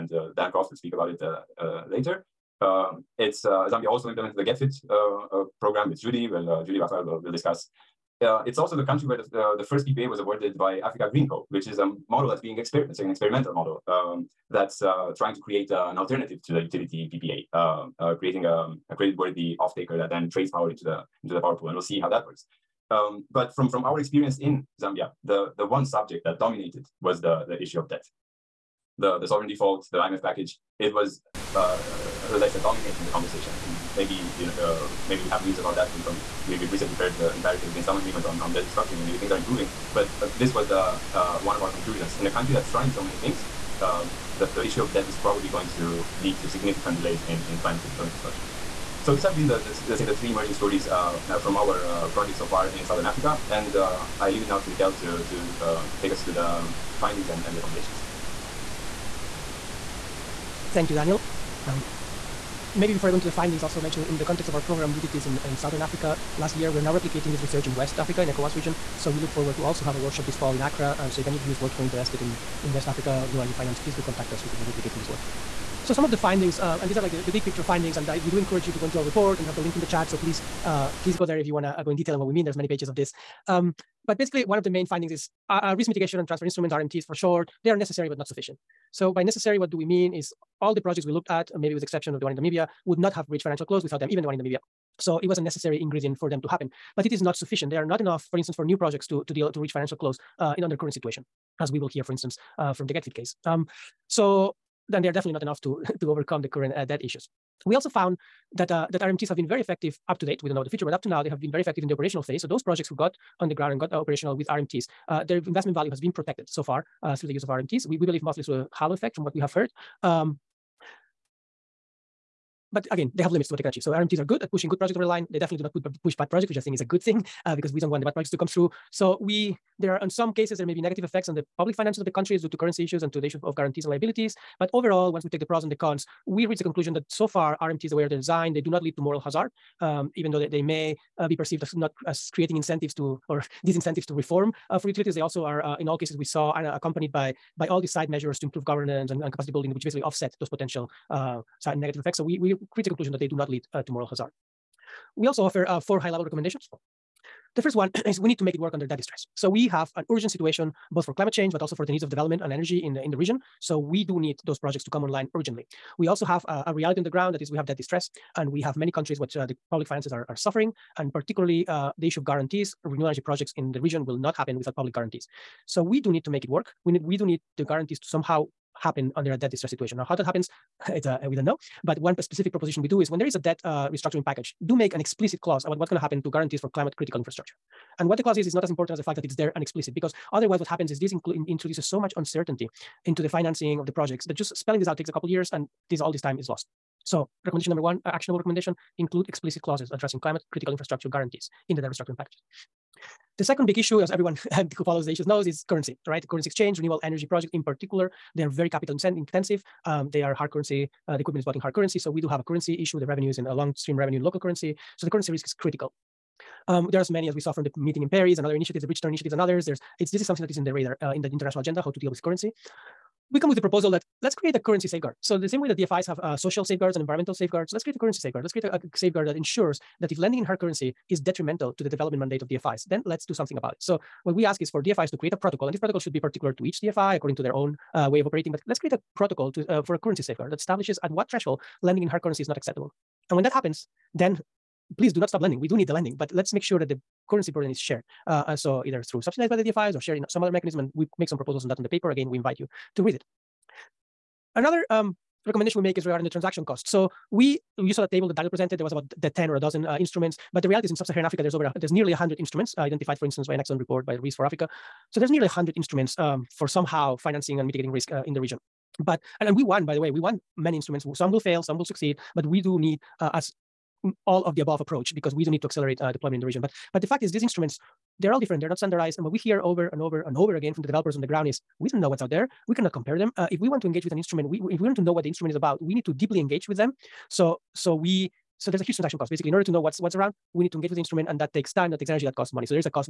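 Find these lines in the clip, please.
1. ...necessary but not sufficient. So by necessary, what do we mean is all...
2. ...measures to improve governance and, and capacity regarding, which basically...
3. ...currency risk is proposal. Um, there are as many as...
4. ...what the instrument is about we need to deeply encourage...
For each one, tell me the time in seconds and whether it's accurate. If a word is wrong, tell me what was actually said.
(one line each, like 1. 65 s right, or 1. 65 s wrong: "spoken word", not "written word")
1. 87 s right
2. 148 s wrong: "building", not "regarding"
3. 215 s wrong: "critical", not "proposal"
4. 285 s wrong: "engage", not "encourage".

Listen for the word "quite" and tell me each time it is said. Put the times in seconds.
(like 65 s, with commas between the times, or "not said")
not said.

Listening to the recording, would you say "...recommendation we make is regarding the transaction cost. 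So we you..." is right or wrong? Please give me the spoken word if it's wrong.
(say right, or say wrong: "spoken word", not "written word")
right.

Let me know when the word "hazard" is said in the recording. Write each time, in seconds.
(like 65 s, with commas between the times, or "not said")
139 s, 154 s.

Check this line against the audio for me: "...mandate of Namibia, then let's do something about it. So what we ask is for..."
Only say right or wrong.
wrong.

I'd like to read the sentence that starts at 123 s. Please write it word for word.
So RMTs are good at pushing good projects over the line.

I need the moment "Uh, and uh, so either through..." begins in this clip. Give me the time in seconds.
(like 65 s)
248 s.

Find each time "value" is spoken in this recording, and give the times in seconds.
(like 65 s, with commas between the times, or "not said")
115 s.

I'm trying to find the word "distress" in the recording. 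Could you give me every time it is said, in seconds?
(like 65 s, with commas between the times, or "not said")
158 s, 167 s, 179 s.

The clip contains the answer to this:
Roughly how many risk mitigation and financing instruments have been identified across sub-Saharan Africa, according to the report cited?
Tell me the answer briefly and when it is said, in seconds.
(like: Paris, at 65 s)
nearly 100, at 265 s.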